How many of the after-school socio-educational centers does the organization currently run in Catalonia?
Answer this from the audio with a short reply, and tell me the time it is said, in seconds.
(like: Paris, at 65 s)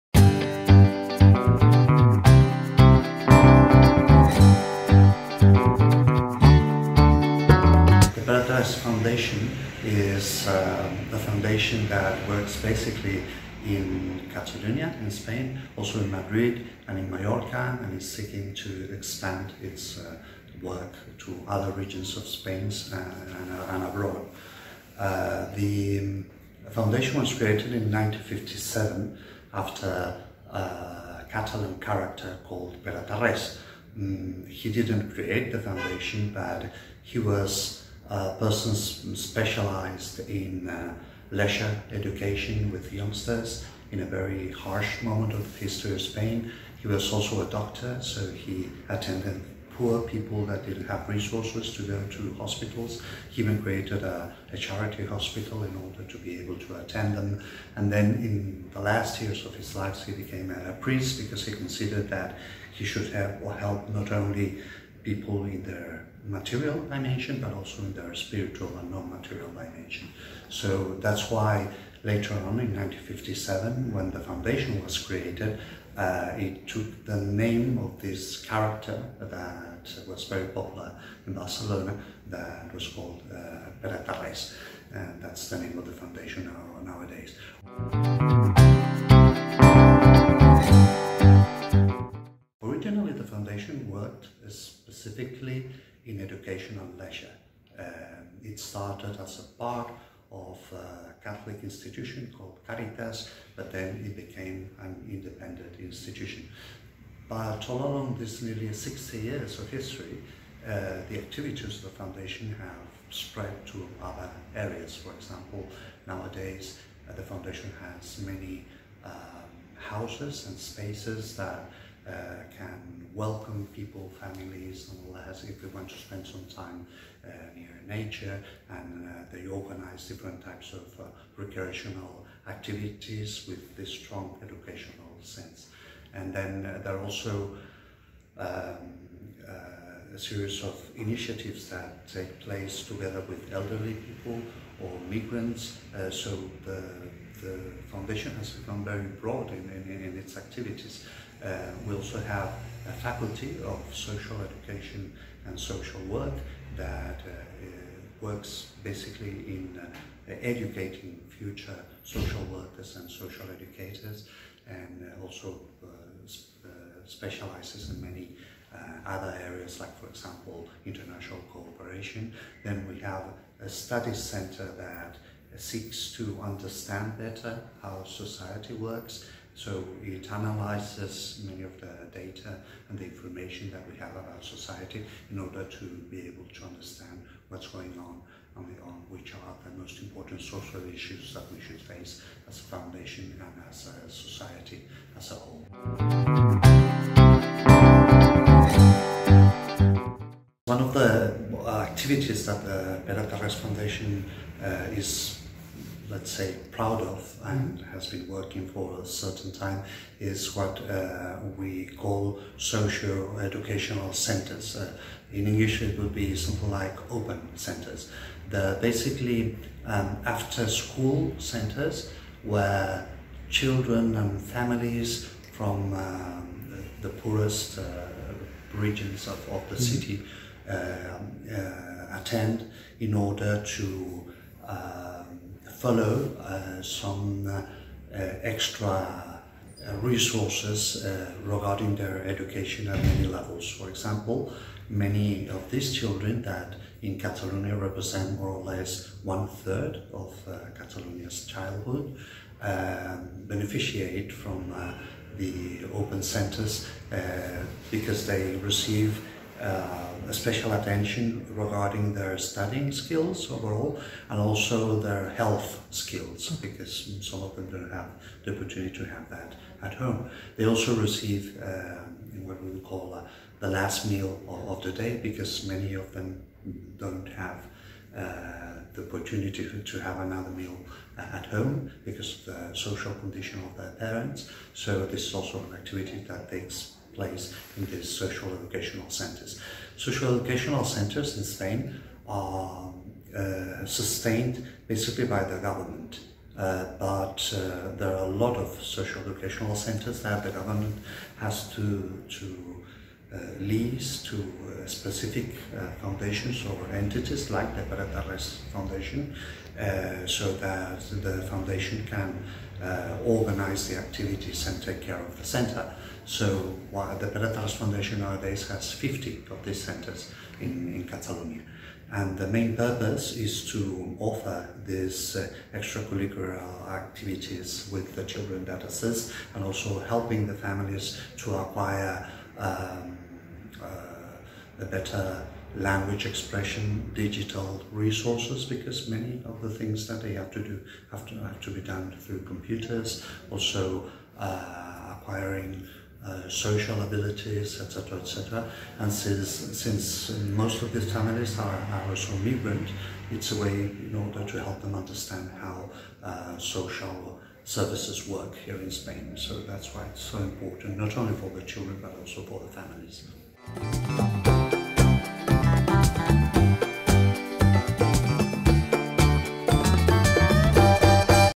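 50, at 318 s.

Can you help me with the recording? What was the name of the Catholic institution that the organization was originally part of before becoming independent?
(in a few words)
Caritas.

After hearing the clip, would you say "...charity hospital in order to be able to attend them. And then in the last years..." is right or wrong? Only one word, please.
right.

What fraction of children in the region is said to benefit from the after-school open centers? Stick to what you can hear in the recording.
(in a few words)
one third.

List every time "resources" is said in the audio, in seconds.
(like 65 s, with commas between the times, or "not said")
51 s, 240 s, 337 s.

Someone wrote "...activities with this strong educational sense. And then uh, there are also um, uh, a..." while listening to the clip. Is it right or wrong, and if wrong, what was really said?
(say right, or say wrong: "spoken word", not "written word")
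right.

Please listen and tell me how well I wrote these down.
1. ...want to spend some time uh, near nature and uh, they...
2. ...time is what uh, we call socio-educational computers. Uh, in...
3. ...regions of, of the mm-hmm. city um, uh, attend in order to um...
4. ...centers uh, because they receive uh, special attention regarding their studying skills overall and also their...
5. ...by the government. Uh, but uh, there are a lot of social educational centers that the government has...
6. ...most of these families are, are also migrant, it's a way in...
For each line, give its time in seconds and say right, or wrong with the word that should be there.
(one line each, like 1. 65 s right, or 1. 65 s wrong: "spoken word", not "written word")
1. 125 s right
2. 209 s wrong: "centers", not "computers"
3. 228 s right
4. 256 s right
5. 295 s right
6. 350 s right.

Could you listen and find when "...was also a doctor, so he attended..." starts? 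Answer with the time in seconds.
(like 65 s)
46 s.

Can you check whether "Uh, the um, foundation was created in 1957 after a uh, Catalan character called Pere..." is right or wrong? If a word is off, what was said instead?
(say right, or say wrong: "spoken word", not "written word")
right.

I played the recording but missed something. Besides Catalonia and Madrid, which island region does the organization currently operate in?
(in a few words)
Mallorca.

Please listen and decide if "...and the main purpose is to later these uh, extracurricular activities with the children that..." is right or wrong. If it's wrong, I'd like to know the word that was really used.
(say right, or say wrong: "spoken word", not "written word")
wrong: "offer", not "later".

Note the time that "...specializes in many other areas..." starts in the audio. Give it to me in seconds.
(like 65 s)
167 s.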